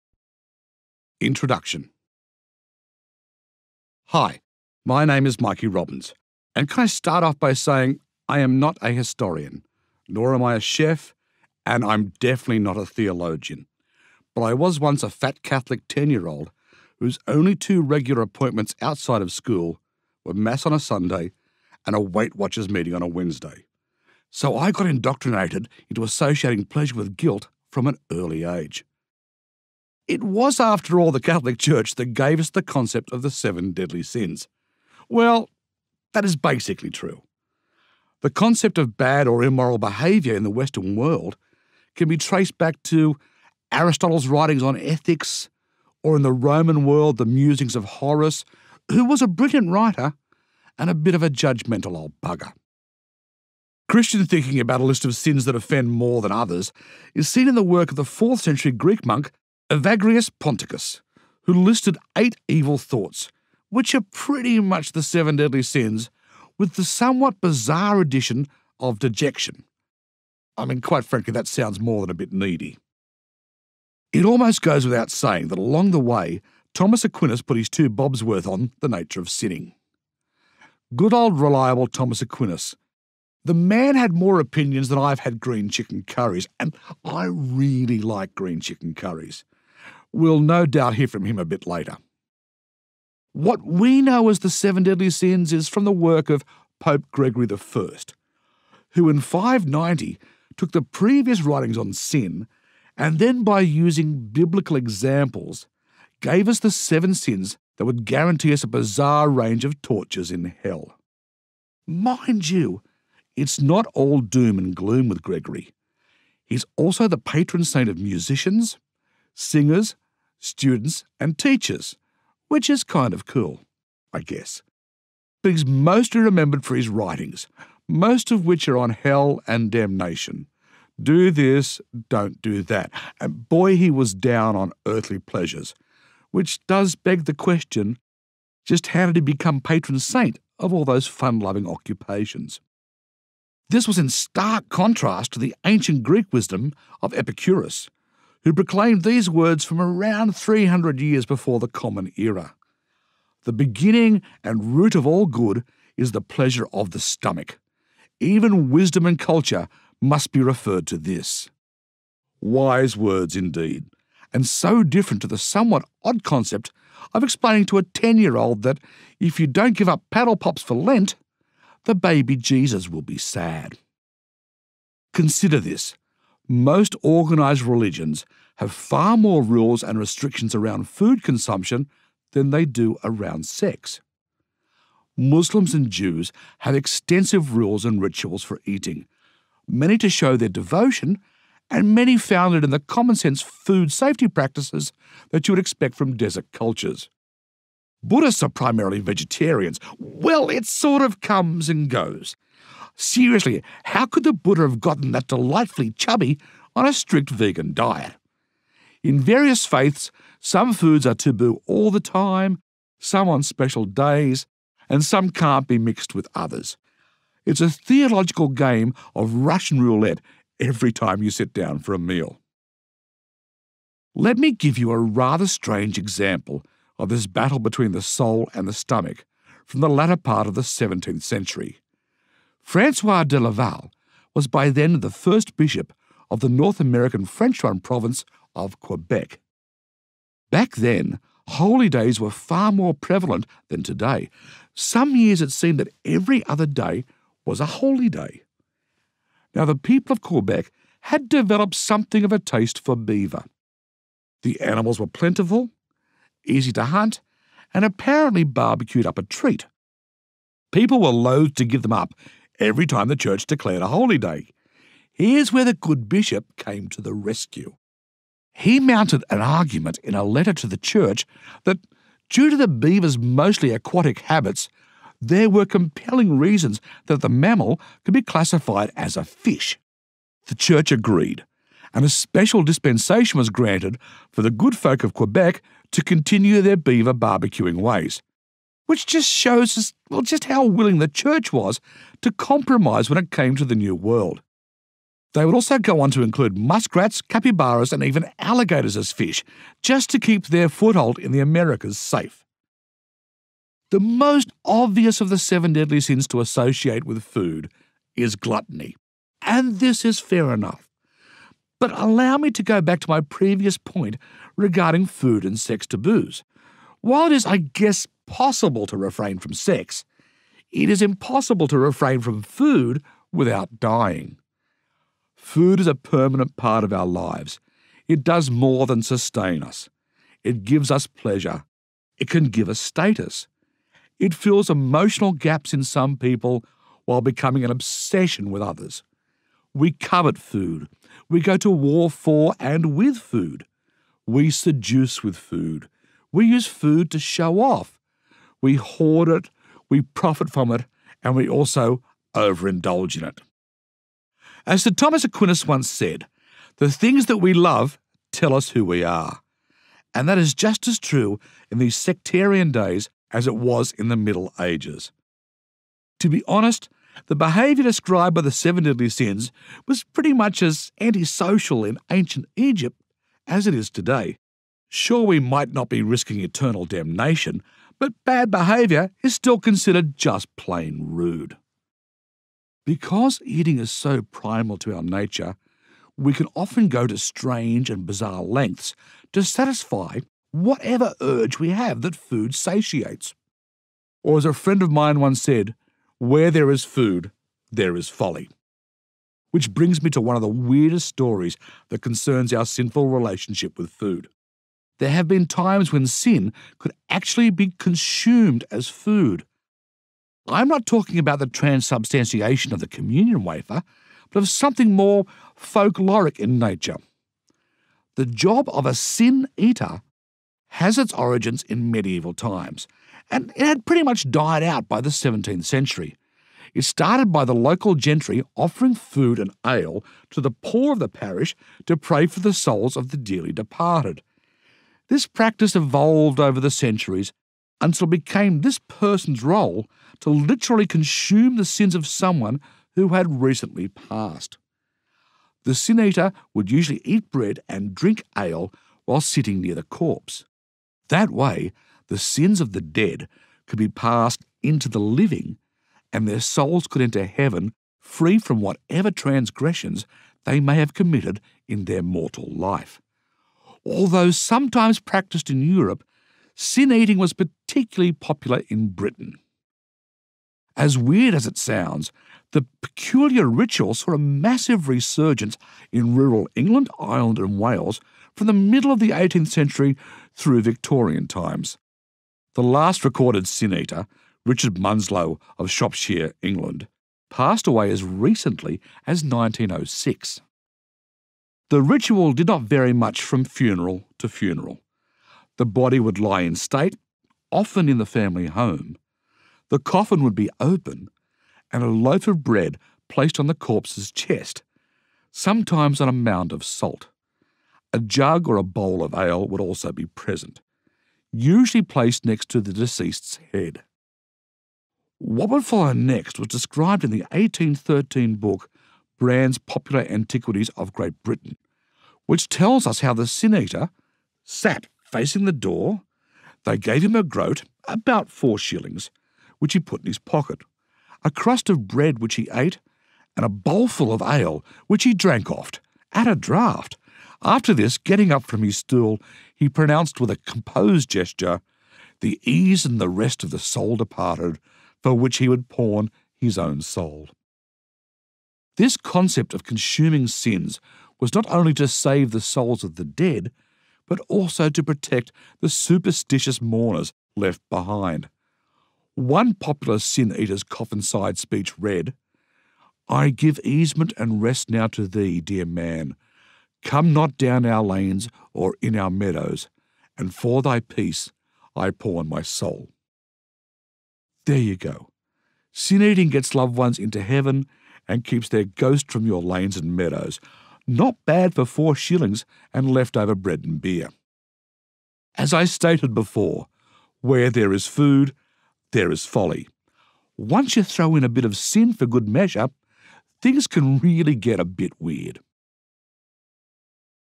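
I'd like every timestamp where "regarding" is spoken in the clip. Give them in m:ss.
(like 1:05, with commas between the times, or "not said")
5:14.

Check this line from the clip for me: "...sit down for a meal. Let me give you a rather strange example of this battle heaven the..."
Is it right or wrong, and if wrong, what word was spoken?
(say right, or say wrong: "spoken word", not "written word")
wrong: "between", not "heaven".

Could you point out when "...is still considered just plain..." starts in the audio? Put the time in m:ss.
6:19.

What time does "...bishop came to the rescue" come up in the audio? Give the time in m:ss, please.
4:26.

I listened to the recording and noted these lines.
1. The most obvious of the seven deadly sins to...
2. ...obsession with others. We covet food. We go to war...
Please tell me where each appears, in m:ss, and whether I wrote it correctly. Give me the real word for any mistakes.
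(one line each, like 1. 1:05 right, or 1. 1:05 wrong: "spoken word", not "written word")
1. 5:03 right
2. 5:37 right.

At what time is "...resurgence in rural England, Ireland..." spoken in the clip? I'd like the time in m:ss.
7:54.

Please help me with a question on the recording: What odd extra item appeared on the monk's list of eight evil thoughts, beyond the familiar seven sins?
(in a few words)
Dejection.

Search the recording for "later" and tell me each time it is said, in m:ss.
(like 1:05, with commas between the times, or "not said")
1:31.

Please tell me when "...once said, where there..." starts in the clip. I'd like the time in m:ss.
6:35.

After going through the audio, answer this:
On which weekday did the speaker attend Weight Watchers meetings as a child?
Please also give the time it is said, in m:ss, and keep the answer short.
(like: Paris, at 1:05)
Wednesday, at 0:23.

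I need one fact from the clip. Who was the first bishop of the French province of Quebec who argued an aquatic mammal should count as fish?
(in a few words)
Francois de Laval.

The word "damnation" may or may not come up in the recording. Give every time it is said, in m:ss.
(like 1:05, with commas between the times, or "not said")
2:09, 6:16.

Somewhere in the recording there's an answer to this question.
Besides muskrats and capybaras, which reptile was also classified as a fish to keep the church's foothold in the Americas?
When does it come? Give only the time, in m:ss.
4:58.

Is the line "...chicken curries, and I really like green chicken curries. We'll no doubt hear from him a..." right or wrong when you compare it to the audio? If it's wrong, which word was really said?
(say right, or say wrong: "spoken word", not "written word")
right.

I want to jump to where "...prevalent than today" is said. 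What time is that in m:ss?
4:02.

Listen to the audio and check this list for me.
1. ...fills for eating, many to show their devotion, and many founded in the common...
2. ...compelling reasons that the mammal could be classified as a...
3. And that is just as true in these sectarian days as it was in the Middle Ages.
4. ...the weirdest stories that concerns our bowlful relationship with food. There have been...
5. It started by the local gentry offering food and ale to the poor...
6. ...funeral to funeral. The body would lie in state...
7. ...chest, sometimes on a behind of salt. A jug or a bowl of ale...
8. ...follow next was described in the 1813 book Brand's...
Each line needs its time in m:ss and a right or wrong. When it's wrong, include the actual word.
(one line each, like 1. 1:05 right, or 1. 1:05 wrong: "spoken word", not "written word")
1. 3:08 wrong: "rituals", not "fills"
2. 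4:35 right
3. 6:00 right
4. 6:40 wrong: "sinful", not "bowlful"
5. 7:06 right
6. 8:13 right
7. 8:24 wrong: "mound", not "behind"
8. 8:35 right.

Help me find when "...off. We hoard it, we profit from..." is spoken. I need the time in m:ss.
5:47.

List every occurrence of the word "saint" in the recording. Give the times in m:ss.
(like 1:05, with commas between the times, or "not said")
1:57, 2:19.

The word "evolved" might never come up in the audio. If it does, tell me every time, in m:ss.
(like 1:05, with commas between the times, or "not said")
7:15.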